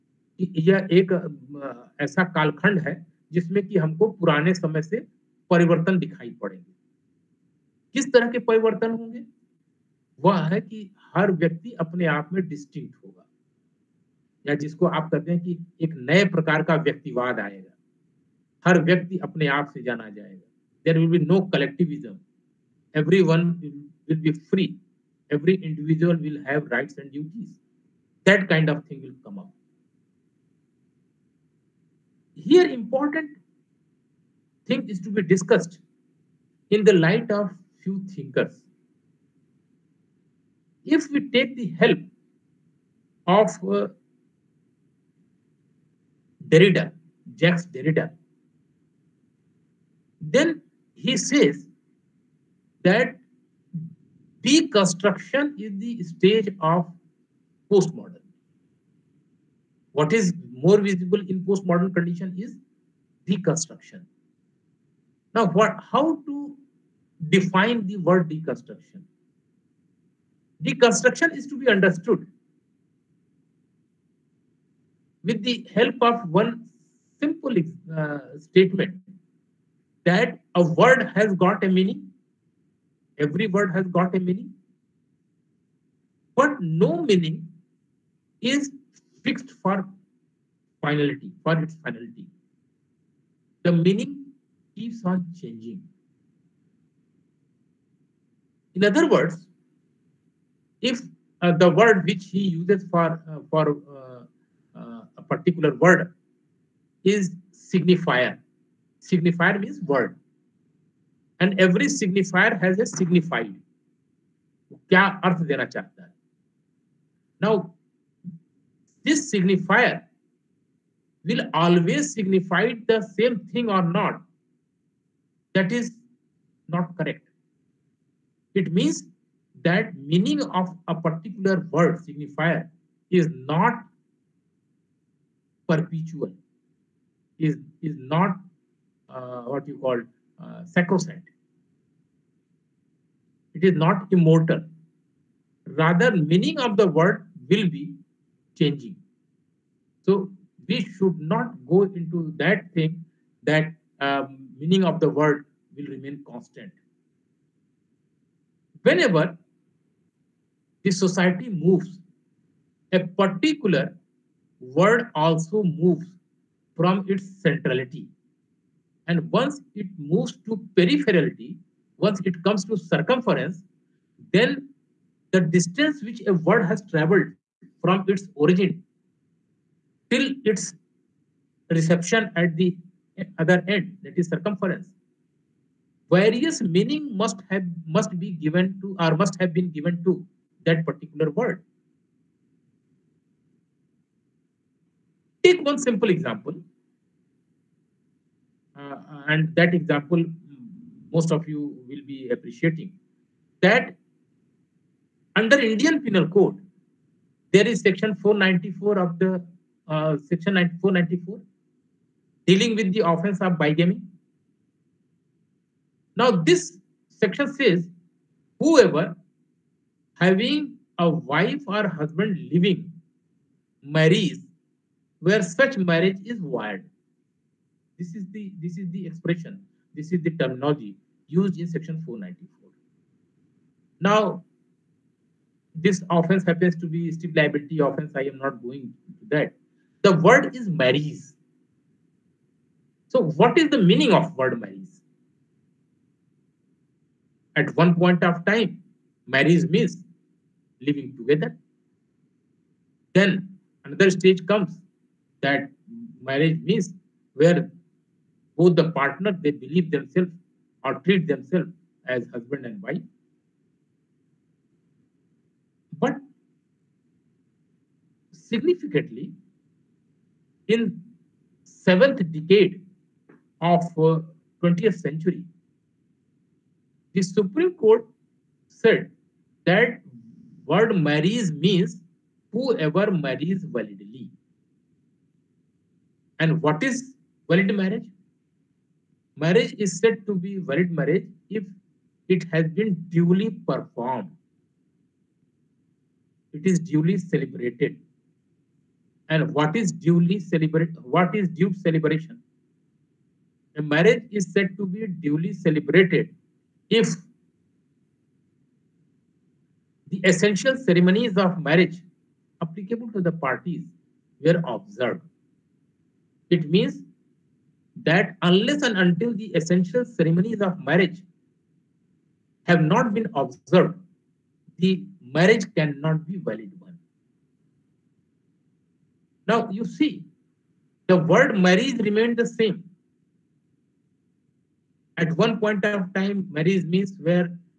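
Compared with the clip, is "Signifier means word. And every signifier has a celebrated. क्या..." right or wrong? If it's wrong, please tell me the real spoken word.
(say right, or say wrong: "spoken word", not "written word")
wrong: "signified", not "celebrated".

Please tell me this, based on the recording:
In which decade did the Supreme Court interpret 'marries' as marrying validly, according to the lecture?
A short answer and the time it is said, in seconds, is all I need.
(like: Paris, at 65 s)
Seventh decade, at 271 s.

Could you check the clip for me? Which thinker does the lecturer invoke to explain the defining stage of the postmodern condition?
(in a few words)
Jacques Derrida.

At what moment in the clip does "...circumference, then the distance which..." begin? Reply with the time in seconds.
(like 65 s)
172 s.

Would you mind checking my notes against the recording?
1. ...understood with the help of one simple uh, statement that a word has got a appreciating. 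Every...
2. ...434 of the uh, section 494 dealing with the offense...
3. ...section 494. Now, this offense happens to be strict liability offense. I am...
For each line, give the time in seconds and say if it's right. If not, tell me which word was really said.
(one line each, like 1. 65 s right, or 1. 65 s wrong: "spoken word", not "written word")
1. 71 s wrong: "meaning", not "appreciating"
2. 208 s wrong: "494", not "434"
3. 231 s right.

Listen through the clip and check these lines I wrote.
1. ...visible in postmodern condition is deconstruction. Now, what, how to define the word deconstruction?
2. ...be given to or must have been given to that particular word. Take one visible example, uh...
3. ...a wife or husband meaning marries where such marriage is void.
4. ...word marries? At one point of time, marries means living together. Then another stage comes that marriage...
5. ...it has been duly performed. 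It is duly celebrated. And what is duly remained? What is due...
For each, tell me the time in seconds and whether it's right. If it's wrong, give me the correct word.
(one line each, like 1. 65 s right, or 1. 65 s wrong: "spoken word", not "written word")
1. 60 s right
2. 188 s wrong: "simple", not "visible"
3. 220 s wrong: "living", not "meaning"
4. 244 s right
5. 292 s wrong: "celebrated", not "remained".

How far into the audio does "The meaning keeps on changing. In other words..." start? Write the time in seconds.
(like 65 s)
93 s.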